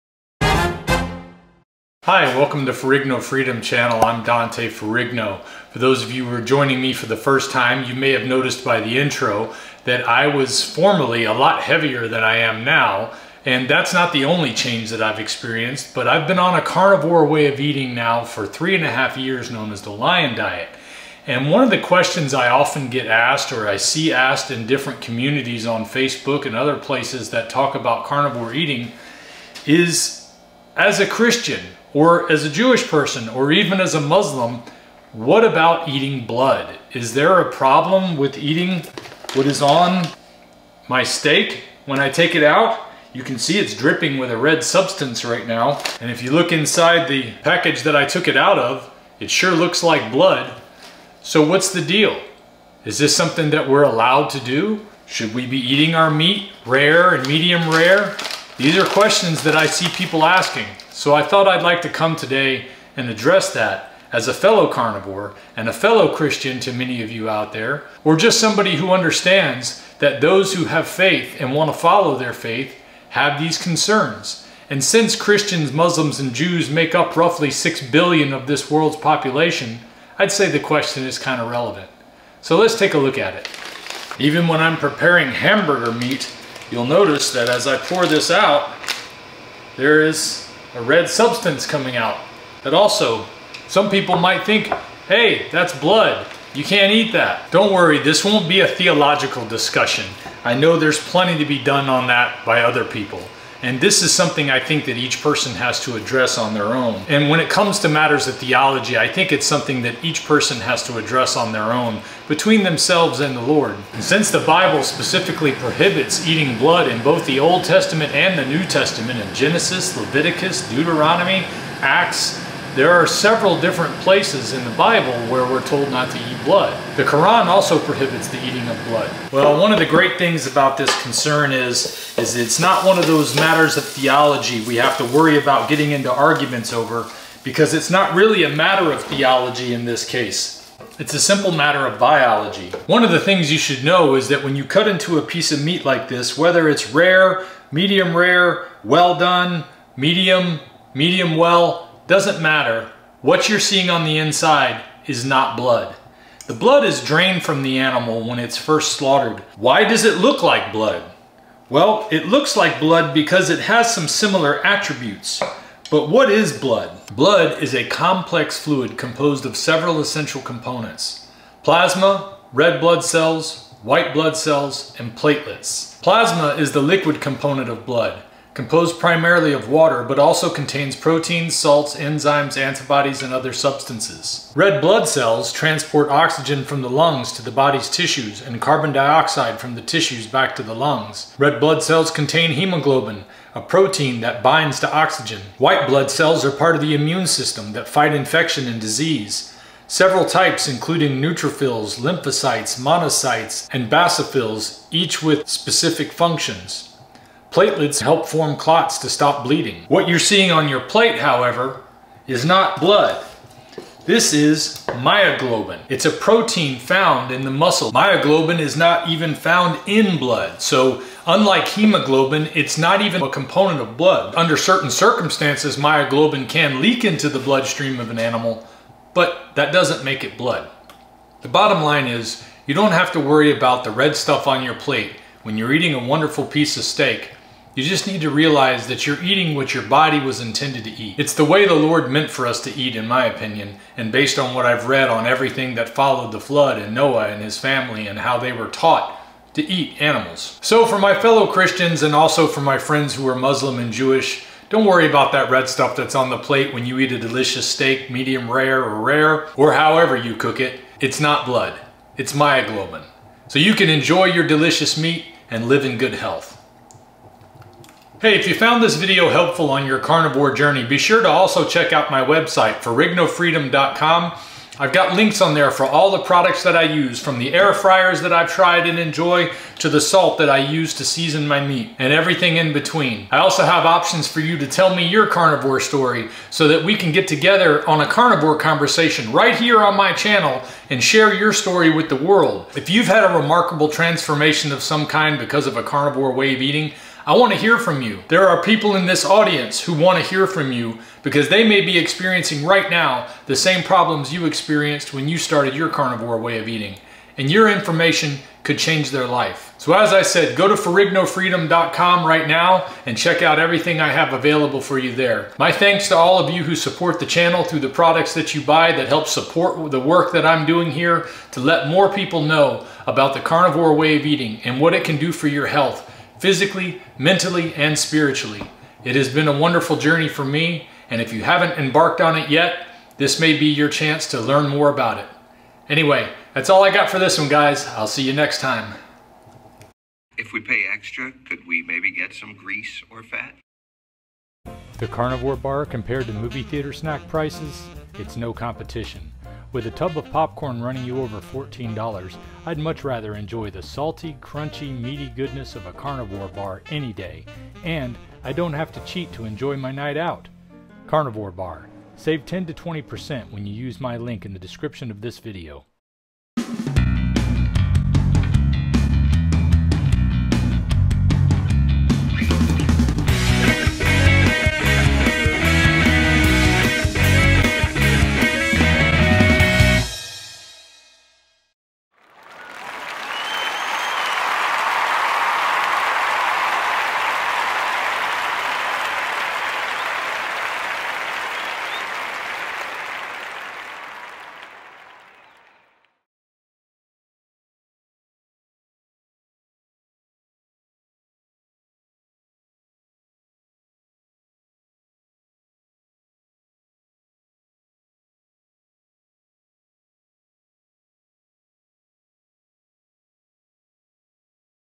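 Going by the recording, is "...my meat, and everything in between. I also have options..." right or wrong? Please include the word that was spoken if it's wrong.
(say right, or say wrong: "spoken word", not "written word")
right.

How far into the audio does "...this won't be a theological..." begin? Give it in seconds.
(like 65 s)
97 s.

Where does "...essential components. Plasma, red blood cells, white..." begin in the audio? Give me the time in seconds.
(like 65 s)
170 s.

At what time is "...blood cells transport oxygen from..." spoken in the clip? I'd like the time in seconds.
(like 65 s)
184 s.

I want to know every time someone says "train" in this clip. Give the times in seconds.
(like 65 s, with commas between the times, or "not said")
not said.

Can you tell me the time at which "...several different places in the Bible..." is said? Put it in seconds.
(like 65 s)
123 s.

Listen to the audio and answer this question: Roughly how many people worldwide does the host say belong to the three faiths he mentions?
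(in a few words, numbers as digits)
6 billion.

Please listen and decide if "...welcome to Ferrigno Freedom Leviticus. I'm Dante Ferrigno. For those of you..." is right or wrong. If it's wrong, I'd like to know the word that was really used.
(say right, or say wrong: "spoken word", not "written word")
wrong: "Channel", not "Leviticus".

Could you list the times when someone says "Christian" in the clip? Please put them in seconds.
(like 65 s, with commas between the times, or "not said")
31 s, 66 s, 75 s, 251 s.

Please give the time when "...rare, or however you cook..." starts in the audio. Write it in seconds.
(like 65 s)
259 s.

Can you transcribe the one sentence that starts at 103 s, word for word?
And this is something I think that each person has to address on their own.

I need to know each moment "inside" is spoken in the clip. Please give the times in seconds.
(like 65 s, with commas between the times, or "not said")
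46 s, 154 s.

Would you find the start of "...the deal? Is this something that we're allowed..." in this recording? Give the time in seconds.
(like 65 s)
51 s.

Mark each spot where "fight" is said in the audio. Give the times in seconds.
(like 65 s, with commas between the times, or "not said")
197 s.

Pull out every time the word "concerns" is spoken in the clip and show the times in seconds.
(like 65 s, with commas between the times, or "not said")
73 s, 131 s.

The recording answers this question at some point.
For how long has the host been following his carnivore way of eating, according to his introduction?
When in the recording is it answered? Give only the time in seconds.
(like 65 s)
18 s.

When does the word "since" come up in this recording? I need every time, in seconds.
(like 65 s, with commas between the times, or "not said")
74 s, 114 s.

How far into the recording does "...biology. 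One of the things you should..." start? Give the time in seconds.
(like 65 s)
141 s.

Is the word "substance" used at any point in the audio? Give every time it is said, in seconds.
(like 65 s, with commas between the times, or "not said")
44 s, 91 s, 183 s.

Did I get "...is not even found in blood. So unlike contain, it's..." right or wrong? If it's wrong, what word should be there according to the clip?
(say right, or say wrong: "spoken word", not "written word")
wrong: "hemoglobin", not "contain".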